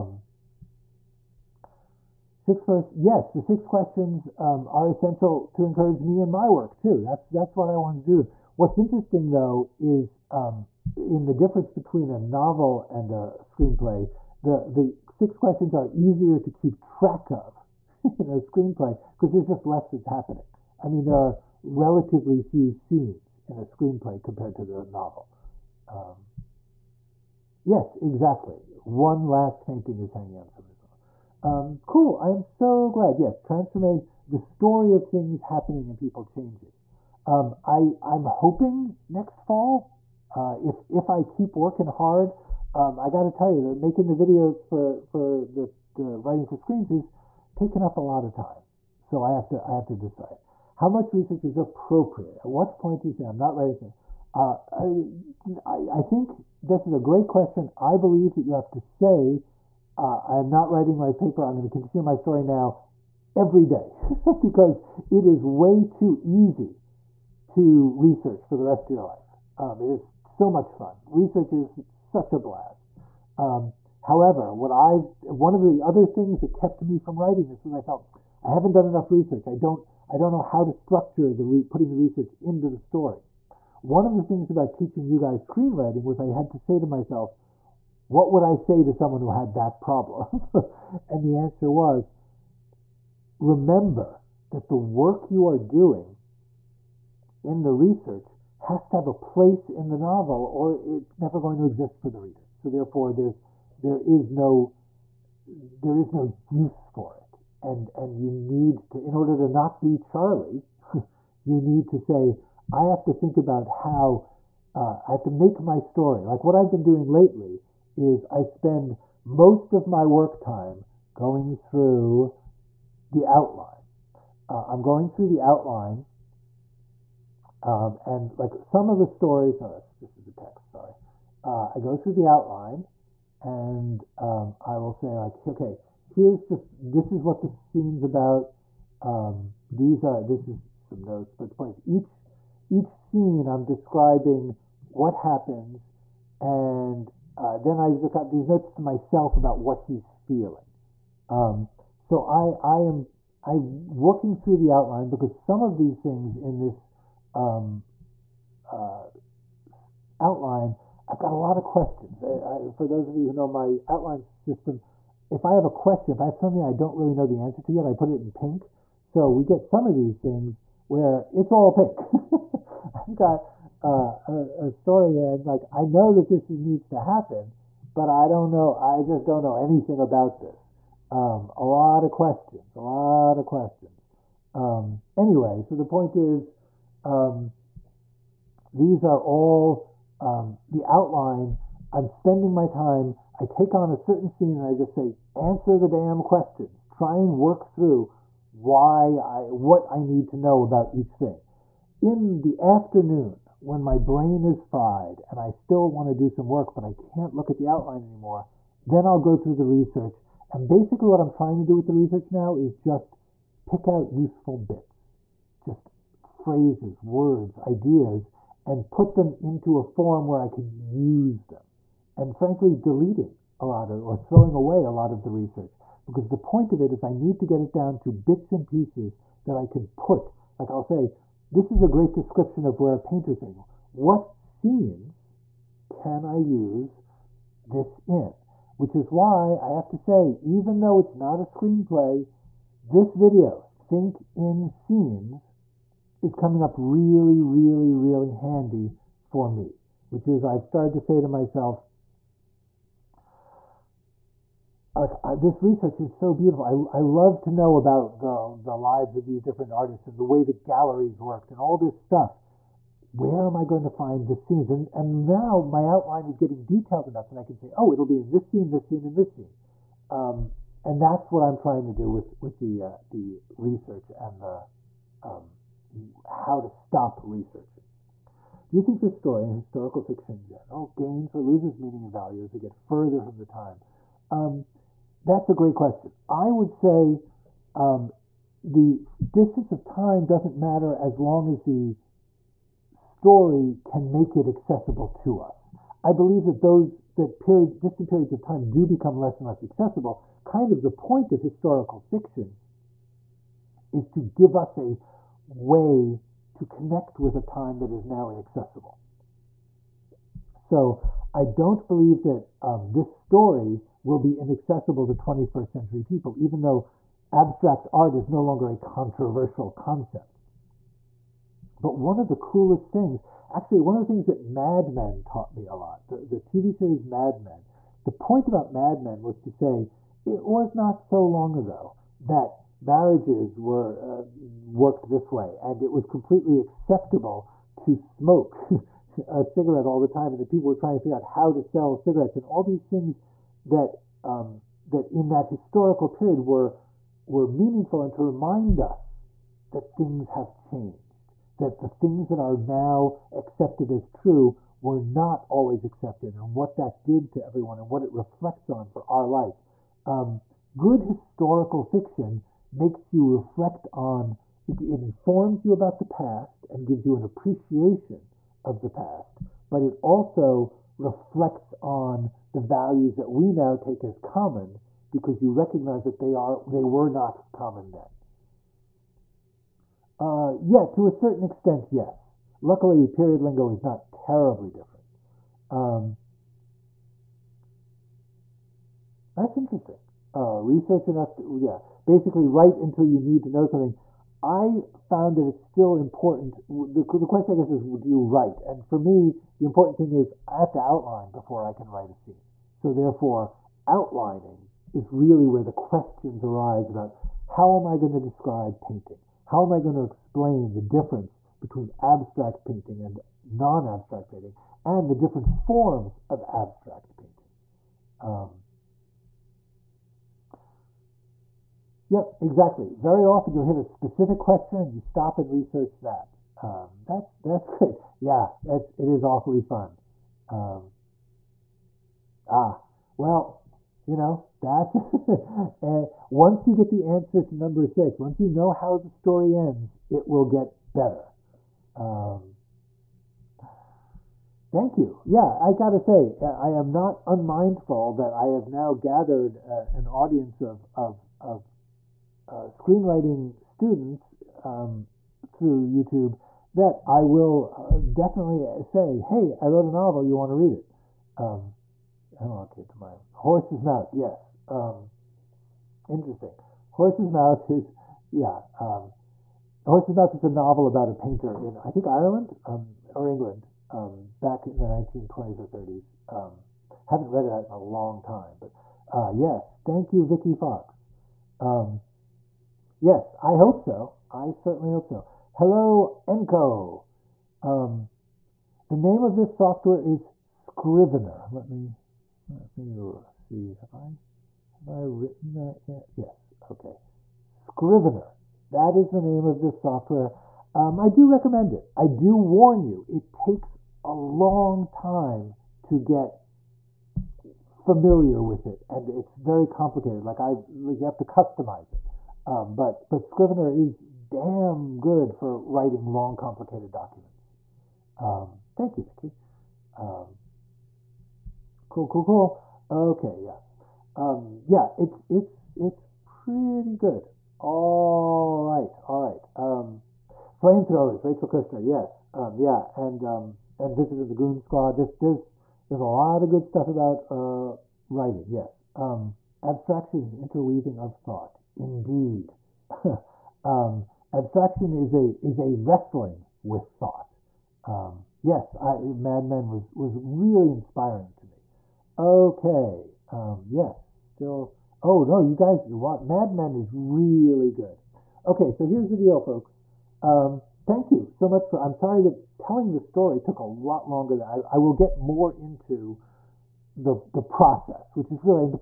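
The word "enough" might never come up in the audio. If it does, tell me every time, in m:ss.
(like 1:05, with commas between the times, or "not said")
1:18, 4:27, 6:31.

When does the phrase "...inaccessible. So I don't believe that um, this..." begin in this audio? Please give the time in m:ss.
5:08.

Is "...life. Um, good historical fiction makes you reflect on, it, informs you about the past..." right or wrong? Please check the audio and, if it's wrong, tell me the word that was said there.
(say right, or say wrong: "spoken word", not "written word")
right.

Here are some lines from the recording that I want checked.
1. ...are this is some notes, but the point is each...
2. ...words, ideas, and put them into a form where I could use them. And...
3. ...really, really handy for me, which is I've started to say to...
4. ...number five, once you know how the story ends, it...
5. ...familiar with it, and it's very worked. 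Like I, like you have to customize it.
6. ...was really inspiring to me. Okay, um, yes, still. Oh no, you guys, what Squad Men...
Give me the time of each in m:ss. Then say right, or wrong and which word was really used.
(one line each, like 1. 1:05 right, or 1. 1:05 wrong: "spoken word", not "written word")
1. 2:20 right
2. 3:37 right
3. 4:07 right
4. 7:17 wrong: "six", not "five"
5. 8:27 wrong: "complicated", not "worked"
6. 9:09 wrong: "Mad", not "Squad".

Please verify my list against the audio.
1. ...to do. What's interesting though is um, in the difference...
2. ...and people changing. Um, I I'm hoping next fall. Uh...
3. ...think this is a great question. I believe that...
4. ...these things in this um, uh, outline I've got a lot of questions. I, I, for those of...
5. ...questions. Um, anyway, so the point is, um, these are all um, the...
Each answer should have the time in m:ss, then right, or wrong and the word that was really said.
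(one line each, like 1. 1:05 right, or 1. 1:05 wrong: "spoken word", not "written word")
1. 0:08 right
2. 0:35 right
3. 0:56 right
4. 2:35 right
5. 3:03 right.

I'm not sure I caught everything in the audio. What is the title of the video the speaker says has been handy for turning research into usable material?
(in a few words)
Think in Scenes.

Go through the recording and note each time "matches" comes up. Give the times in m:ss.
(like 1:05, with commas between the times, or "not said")
not said.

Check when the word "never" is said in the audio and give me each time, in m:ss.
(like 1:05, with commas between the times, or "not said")
1:41.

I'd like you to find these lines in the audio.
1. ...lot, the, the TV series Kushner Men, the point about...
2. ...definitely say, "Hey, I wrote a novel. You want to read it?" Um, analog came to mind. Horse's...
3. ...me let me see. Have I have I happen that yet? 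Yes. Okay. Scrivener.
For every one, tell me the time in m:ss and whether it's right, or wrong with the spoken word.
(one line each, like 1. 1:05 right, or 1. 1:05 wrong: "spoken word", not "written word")
1. 5:25 wrong: "Mad", not "Kushner"
2. 7:38 right
3. 8:11 wrong: "written", not "happen".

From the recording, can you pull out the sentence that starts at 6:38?
And for me, the important thing is I have to outline before I can write a scene.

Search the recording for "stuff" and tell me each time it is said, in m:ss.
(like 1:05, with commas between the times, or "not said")
4:21, 8:56.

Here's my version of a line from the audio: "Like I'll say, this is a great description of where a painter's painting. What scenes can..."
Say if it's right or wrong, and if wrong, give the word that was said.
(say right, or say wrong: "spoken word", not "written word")
right.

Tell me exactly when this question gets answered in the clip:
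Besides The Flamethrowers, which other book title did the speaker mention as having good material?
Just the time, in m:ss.
8:53.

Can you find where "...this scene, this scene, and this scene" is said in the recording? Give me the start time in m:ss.
4:28.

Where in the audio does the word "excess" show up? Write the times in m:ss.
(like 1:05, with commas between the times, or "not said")
not said.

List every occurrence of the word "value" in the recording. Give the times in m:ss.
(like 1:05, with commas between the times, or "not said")
4:42, 6:12.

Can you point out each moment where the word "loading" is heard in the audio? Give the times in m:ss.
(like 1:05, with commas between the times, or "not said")
not said.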